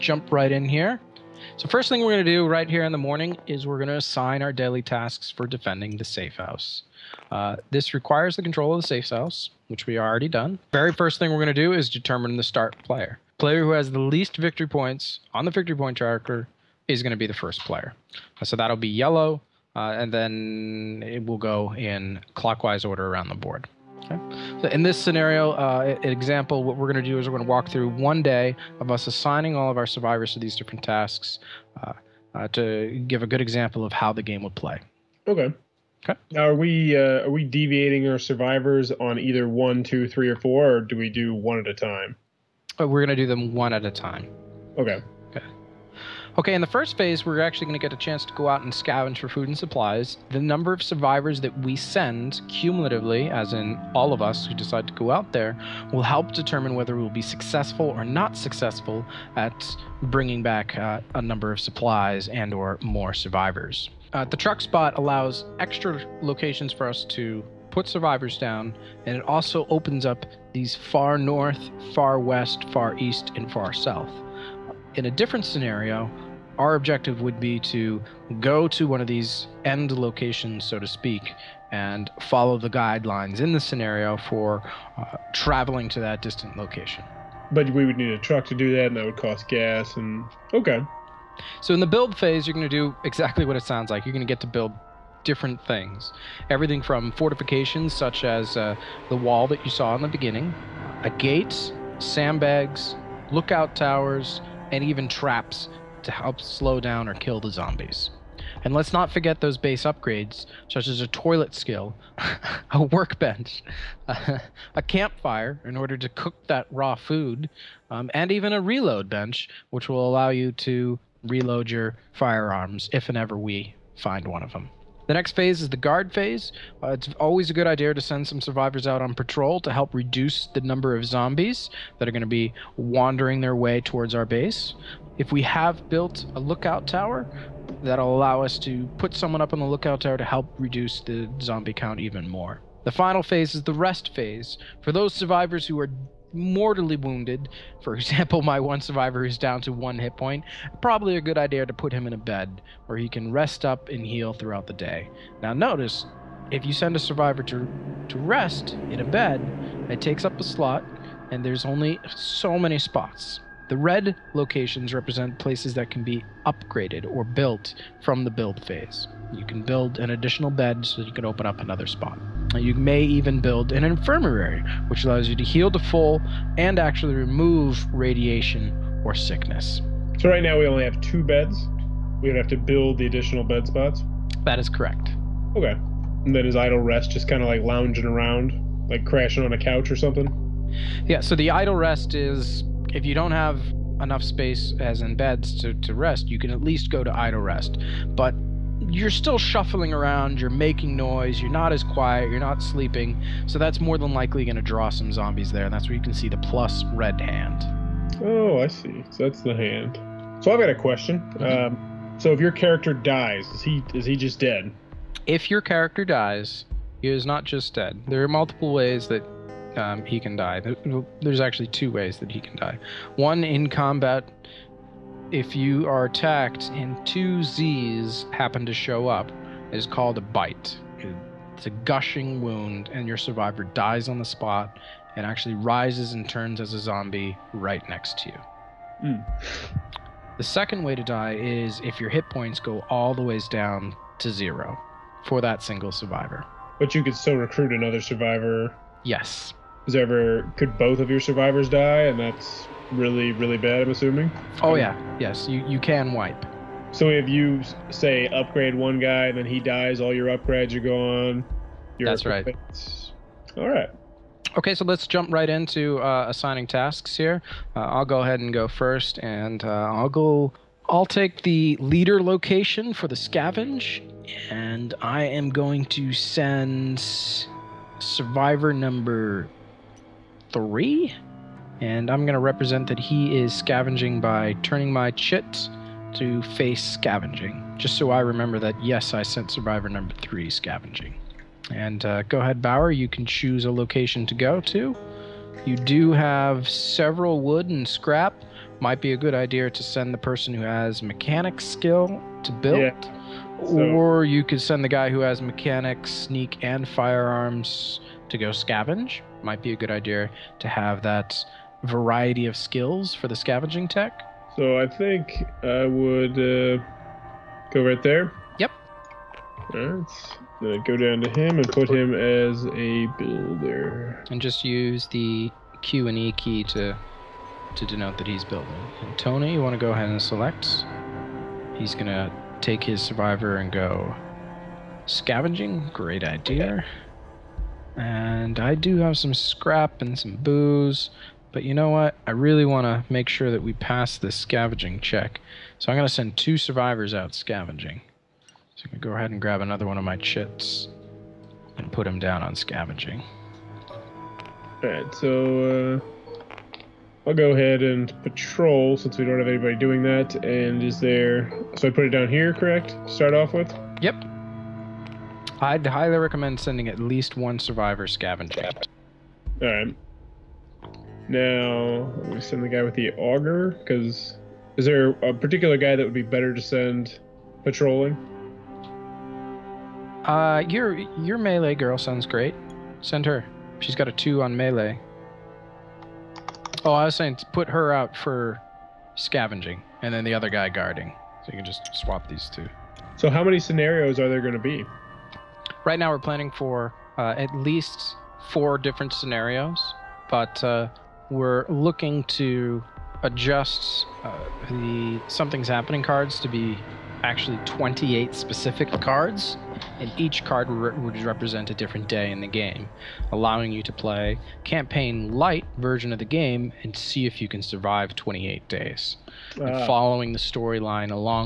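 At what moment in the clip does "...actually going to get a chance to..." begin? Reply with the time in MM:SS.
00:47.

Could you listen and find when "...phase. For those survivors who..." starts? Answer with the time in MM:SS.
02:24.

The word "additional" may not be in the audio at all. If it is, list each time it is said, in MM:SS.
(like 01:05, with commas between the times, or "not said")
02:50, 03:03.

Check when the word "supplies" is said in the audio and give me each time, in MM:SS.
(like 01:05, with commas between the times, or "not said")
00:49, 01:01.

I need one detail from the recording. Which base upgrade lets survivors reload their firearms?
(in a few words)
reload bench.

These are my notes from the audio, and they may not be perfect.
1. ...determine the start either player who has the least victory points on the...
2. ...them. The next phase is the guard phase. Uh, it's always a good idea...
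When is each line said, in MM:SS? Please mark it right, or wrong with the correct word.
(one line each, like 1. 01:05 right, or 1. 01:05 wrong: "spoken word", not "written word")
1. 00:11 wrong: "player", not "either"
2. 02:04 right.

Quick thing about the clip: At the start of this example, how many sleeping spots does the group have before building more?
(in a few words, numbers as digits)
2.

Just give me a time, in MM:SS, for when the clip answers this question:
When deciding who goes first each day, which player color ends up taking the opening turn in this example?
00:18.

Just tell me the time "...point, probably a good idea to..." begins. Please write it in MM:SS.
02:30.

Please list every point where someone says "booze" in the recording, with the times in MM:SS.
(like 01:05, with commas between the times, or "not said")
05:40.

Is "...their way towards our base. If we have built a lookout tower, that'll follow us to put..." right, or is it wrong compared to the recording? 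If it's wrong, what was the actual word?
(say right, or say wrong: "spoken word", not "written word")
wrong: "allow", not "follow".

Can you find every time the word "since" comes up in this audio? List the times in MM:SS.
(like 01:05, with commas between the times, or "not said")
05:58.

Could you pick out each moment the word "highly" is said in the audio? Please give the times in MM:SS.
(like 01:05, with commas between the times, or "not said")
06:05.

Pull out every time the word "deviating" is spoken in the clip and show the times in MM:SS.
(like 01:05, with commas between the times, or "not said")
00:37.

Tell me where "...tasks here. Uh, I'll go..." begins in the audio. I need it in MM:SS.
04:26.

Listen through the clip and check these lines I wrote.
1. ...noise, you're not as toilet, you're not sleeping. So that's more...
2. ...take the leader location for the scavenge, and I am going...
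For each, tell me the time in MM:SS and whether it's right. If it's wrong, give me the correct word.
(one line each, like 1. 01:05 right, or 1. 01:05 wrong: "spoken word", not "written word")
1. 03:20 wrong: "quiet", not "toilet"
2. 04:31 right.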